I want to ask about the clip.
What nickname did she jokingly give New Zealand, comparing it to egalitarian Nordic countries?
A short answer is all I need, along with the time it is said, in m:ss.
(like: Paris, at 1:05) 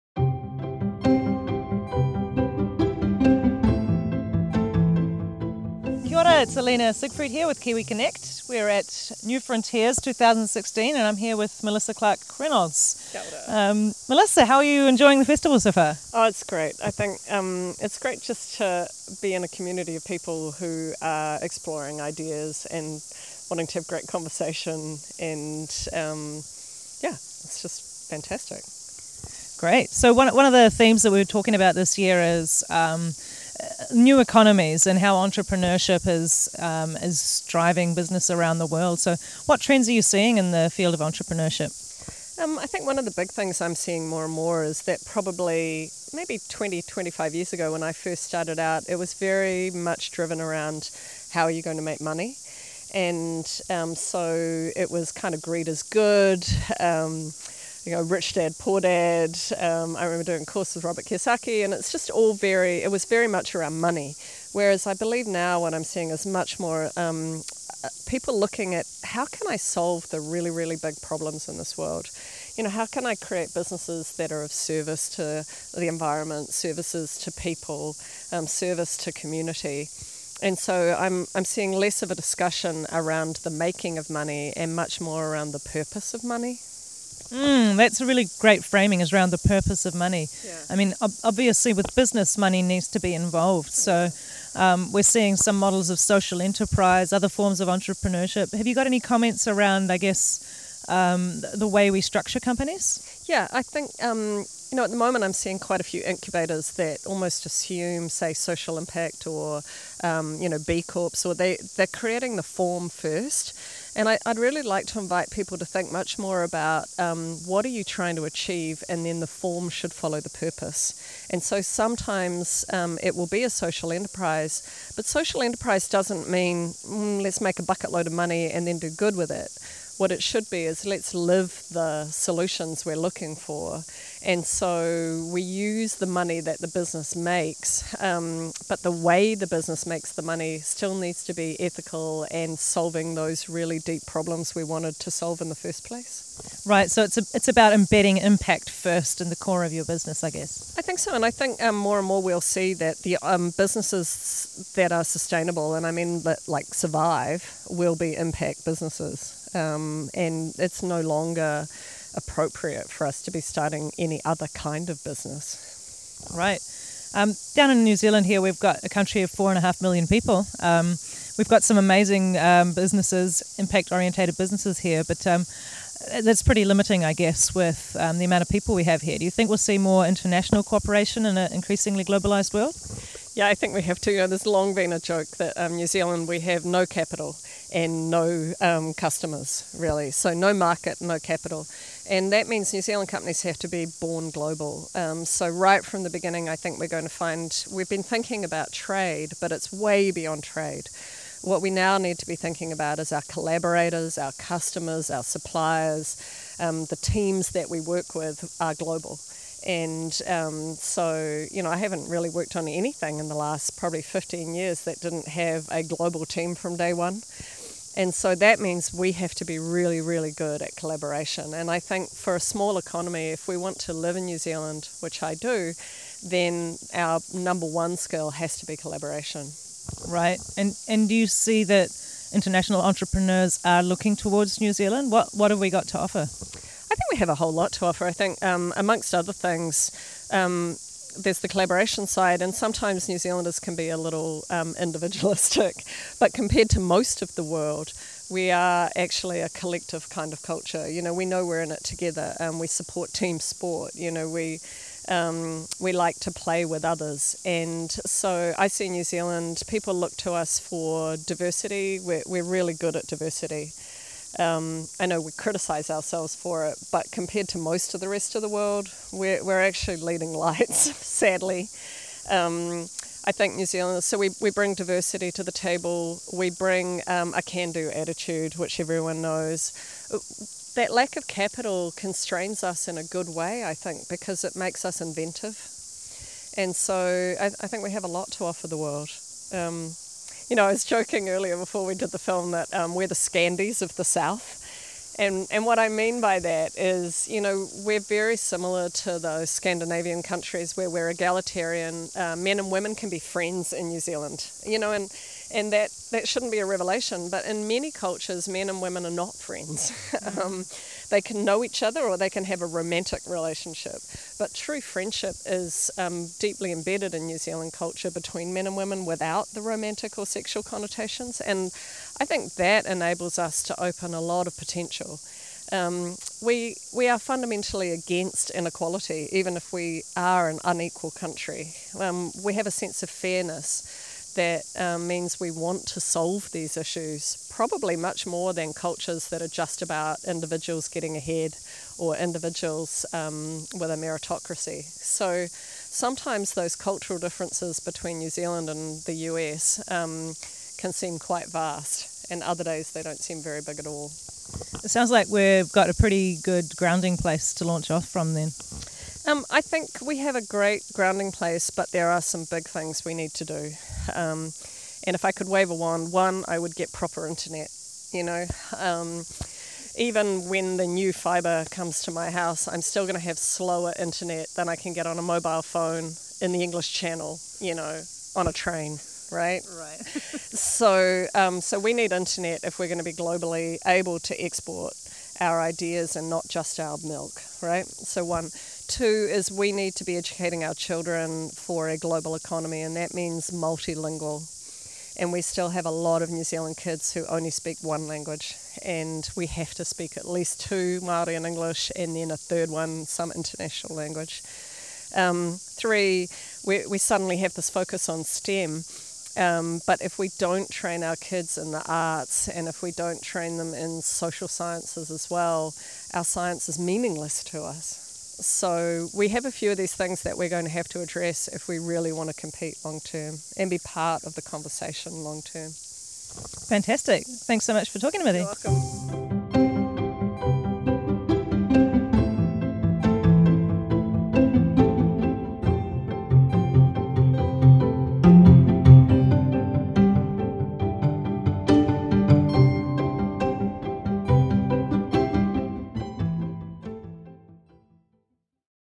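Scandies of the South, at 4:53.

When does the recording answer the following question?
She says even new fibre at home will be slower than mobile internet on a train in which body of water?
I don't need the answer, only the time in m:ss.
6:16.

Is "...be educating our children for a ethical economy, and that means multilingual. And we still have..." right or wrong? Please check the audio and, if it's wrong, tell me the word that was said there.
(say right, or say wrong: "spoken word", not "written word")
wrong: "global", not "ethical".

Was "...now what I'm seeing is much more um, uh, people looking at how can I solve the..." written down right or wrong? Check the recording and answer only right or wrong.
right.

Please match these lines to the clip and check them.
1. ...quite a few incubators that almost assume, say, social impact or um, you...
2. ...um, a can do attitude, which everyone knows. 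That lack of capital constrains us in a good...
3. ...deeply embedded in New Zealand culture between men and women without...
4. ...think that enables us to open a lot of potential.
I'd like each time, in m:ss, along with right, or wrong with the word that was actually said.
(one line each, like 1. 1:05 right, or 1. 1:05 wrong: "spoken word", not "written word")
1. 1:45 right
2. 4:37 right
3. 5:16 right
4. 5:22 right.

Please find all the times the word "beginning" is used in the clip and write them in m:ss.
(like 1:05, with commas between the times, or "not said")
3:16.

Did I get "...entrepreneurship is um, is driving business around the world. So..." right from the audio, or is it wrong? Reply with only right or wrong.
right.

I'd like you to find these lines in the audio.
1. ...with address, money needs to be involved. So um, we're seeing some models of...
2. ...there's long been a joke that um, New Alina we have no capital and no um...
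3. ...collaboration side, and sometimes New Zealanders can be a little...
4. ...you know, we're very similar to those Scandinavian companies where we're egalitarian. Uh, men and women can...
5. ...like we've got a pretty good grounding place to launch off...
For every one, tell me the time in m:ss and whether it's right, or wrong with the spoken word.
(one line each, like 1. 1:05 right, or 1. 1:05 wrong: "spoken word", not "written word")
1. 1:31 wrong: "business", not "address"
2. 3:04 wrong: "Zealand", not "Alina"
3. 4:01 right
4. 4:57 wrong: "countries", not "companies"
5. 5:55 right.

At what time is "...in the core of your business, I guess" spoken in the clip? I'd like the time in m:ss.
2:29.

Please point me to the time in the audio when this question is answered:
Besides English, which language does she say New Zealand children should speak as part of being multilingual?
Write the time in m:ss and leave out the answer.
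6:41.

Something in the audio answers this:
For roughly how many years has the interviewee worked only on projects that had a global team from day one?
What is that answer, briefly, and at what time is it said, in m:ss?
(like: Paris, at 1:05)
15 years, at 3:34.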